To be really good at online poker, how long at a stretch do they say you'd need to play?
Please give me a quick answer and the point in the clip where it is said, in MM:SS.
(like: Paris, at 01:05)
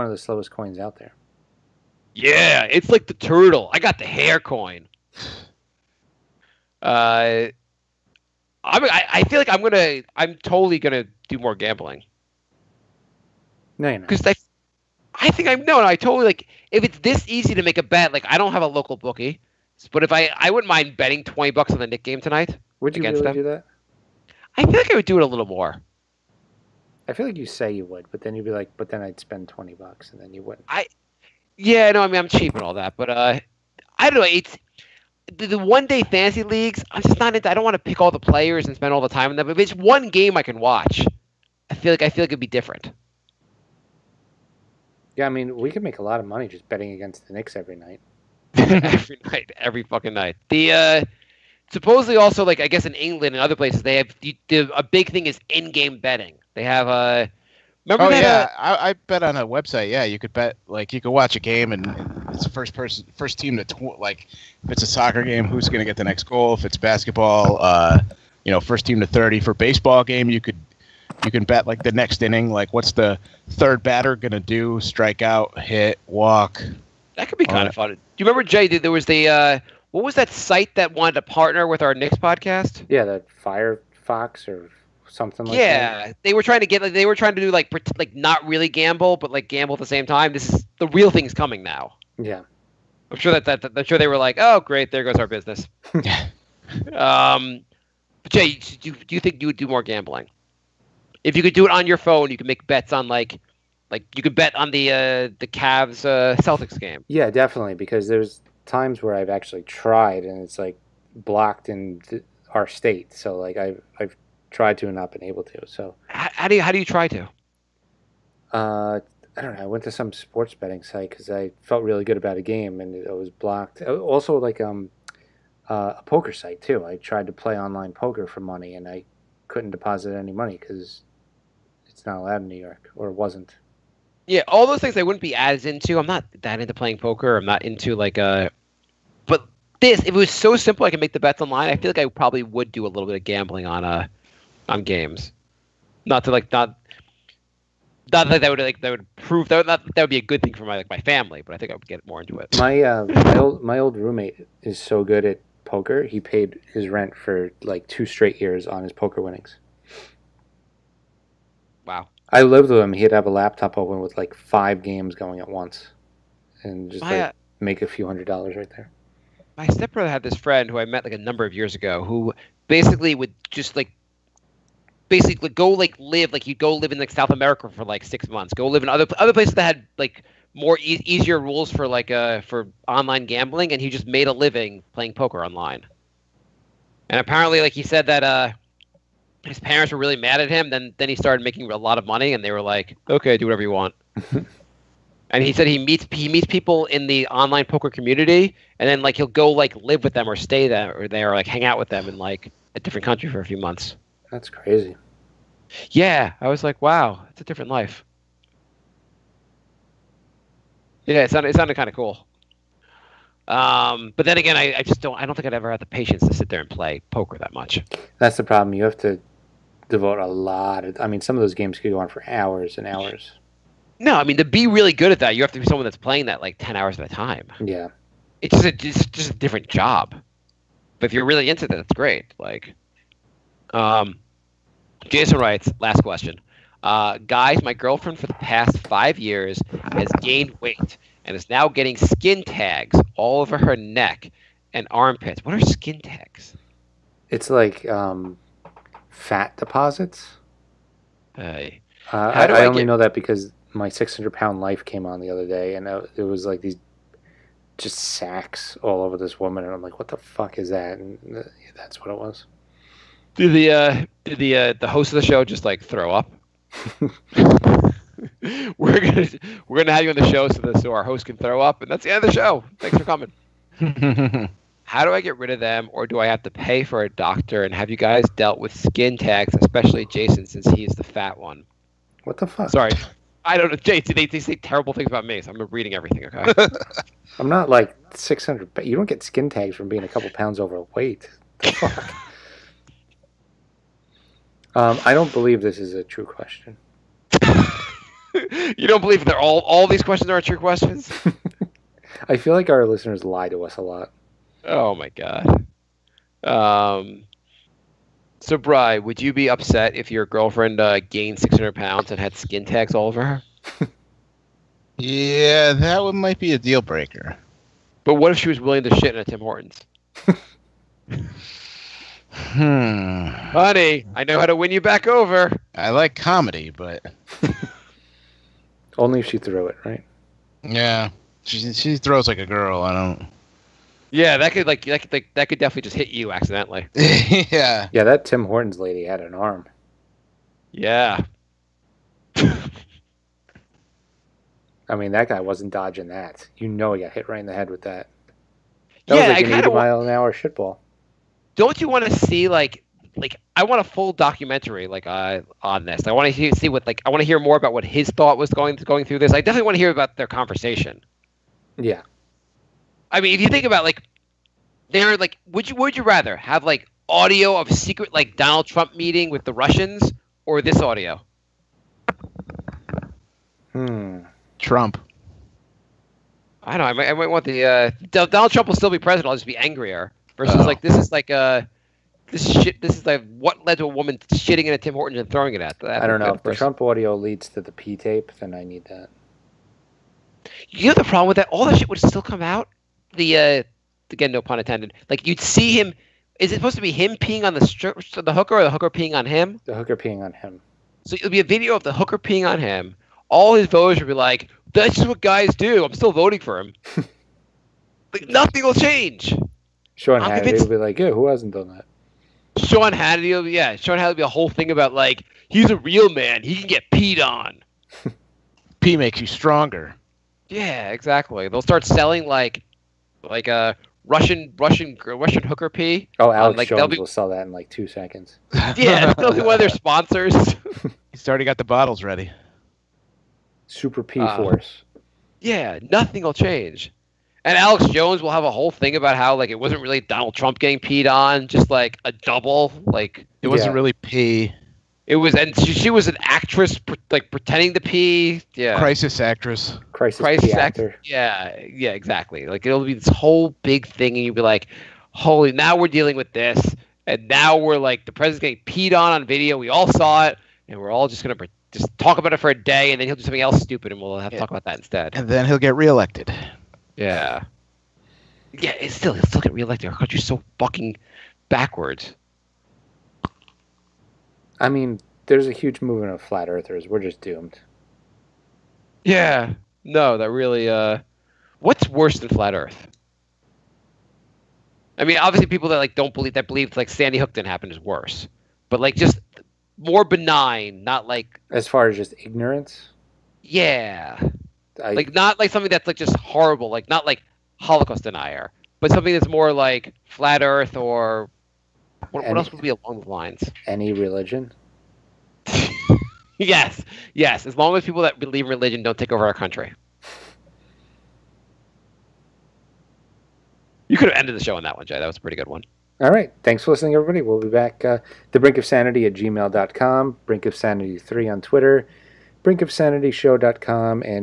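10 hours, at 03:46.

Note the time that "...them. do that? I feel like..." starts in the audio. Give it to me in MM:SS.
00:23.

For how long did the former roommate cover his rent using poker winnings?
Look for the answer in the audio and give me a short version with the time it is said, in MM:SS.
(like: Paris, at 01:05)
2 years, at 02:37.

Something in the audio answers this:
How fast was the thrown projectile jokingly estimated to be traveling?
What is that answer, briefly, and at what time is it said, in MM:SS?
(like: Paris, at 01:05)
80 mph, at 05:49.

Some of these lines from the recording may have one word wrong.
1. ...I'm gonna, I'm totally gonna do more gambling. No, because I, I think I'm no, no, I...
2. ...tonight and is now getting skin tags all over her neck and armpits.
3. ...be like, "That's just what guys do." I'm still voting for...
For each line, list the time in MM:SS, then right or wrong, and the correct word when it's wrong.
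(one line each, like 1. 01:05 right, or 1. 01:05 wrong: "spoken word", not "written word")
1. 00:09 right
2. 04:00 wrong: "weight", not "tonight"
3. 06:44 right.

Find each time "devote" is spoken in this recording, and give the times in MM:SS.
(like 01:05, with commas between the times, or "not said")
03:39.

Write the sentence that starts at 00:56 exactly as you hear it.
Uh, Remember oh that, yeah, uh, I, I, bet on a website.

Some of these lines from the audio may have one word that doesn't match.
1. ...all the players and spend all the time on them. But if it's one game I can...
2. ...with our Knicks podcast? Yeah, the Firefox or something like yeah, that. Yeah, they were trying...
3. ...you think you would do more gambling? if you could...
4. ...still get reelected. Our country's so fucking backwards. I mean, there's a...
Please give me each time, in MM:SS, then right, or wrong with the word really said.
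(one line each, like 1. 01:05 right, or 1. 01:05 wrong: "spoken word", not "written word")
1. 00:38 right
2. 01:21 right
3. 01:39 right
4. 07:49 right.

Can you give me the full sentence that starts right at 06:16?
Know, I might, I might want the uh, Donald Trump will still be president.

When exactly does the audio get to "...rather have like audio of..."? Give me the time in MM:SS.
06:06.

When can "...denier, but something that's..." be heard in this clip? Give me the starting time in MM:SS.
08:18.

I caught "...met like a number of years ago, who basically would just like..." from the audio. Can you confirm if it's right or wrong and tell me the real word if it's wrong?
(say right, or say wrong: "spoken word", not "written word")
right.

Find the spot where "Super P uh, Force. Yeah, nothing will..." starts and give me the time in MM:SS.
07:13.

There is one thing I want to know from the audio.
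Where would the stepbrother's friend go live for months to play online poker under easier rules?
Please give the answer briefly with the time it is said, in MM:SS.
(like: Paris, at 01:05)
South America, at 02:57.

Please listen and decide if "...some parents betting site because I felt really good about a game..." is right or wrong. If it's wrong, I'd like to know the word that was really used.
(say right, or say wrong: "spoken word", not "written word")
wrong: "sports", not "parents".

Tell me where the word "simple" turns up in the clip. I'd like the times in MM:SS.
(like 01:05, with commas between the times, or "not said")
02:20.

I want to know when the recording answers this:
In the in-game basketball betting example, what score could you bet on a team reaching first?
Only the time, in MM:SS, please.
01:09.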